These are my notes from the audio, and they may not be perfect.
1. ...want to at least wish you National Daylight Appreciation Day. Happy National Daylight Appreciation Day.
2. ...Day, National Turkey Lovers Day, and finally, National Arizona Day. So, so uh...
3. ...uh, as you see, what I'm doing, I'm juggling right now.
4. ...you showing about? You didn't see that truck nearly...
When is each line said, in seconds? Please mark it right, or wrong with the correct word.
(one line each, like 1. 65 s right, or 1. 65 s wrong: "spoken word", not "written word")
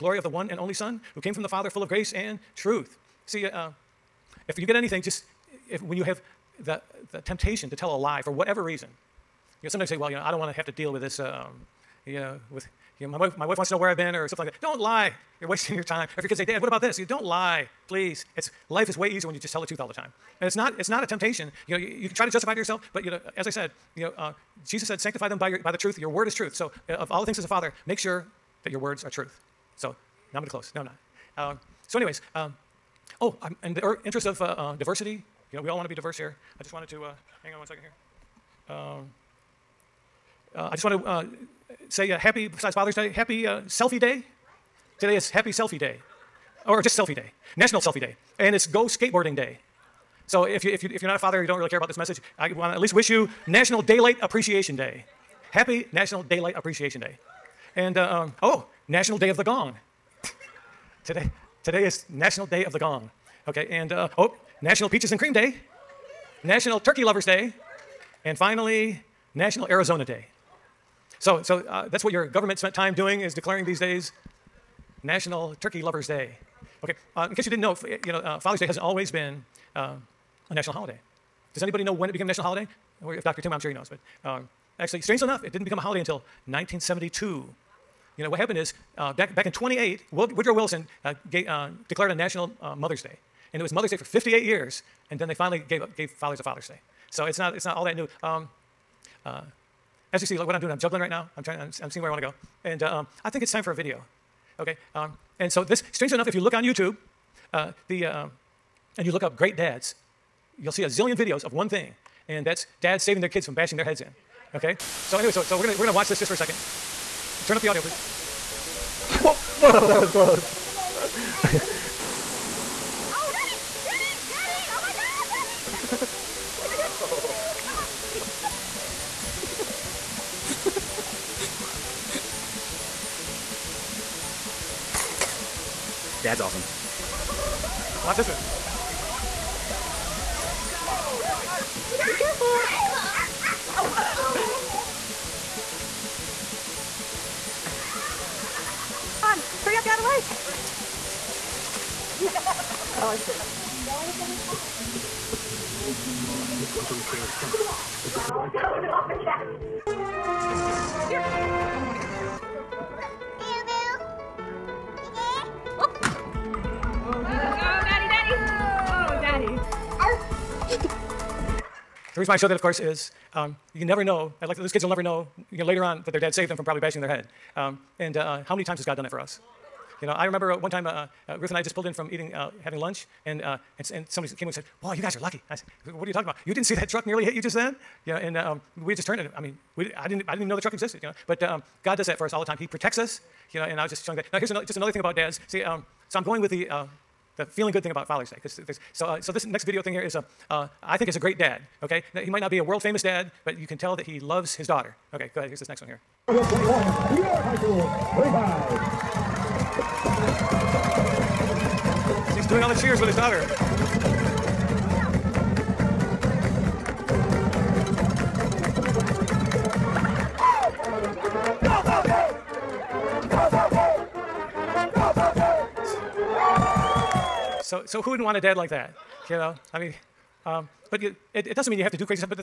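1. 52 s right
2. 65 s right
3. 99 s right
4. 186 s wrong: "talking", not "showing".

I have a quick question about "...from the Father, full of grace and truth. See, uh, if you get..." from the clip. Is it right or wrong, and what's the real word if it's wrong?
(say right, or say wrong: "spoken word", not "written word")
right.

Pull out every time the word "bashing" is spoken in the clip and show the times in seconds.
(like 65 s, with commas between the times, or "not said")
113 s, 176 s.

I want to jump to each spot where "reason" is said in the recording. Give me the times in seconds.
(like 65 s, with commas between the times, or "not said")
8 s, 172 s.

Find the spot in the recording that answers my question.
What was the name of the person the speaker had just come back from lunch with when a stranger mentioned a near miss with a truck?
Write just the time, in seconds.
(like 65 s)
181 s.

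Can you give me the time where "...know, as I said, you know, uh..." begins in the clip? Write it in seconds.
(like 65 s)
23 s.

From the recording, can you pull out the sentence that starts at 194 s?
Now, here's another, just another thing about dads.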